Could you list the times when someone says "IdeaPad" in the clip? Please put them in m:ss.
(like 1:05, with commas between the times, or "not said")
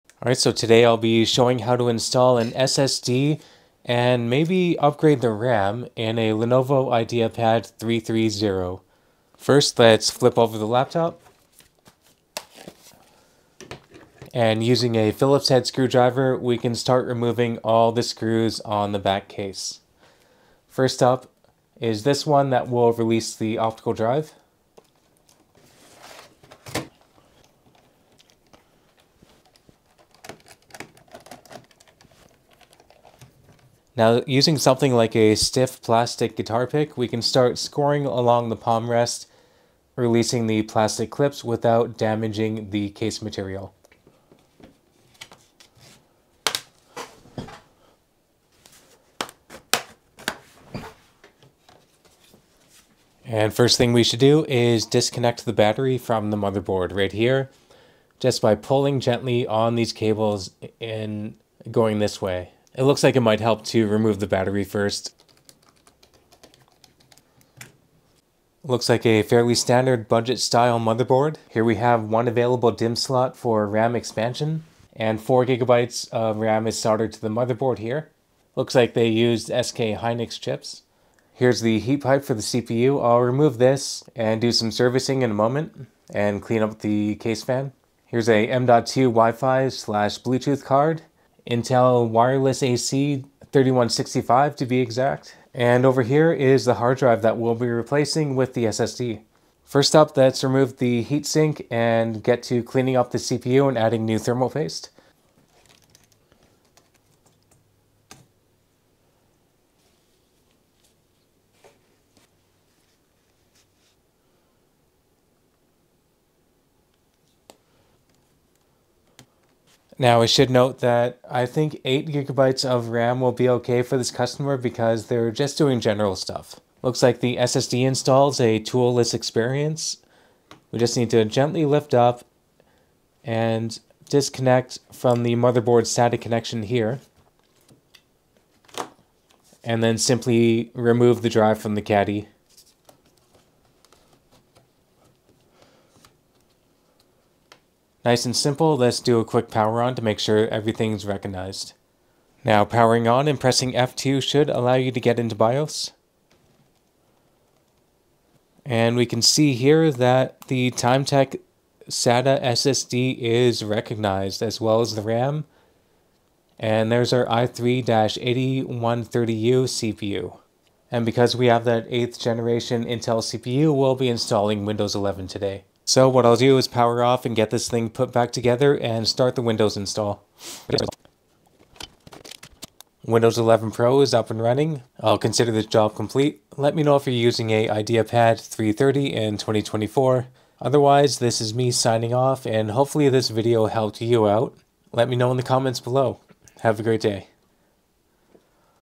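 0:06, 3:07.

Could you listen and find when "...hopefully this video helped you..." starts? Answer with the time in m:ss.
3:12.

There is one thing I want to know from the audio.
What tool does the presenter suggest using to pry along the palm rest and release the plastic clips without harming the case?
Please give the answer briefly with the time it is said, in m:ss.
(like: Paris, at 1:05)
Stiff plastic guitar pick, at 0:35.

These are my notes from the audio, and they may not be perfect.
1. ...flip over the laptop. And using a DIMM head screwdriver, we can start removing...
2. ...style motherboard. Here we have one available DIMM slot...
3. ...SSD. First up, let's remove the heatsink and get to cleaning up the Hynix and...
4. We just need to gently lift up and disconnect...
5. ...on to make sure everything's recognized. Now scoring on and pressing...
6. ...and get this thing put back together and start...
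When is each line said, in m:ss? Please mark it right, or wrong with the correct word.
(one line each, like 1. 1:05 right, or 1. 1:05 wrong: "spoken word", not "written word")
1. 0:10 wrong: "Phillips", not "DIMM"
2. 1:10 right
3. 1:38 wrong: "CPU", not "Hynix"
4. 2:10 right
5. 2:29 wrong: "powering", not "scoring"
6. 2:57 right.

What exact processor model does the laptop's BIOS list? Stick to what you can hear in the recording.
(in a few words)
i3-8130U.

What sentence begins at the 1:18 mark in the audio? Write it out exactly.
Looks like they used SK Hynix chips.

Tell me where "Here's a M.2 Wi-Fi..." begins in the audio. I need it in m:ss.
1:28.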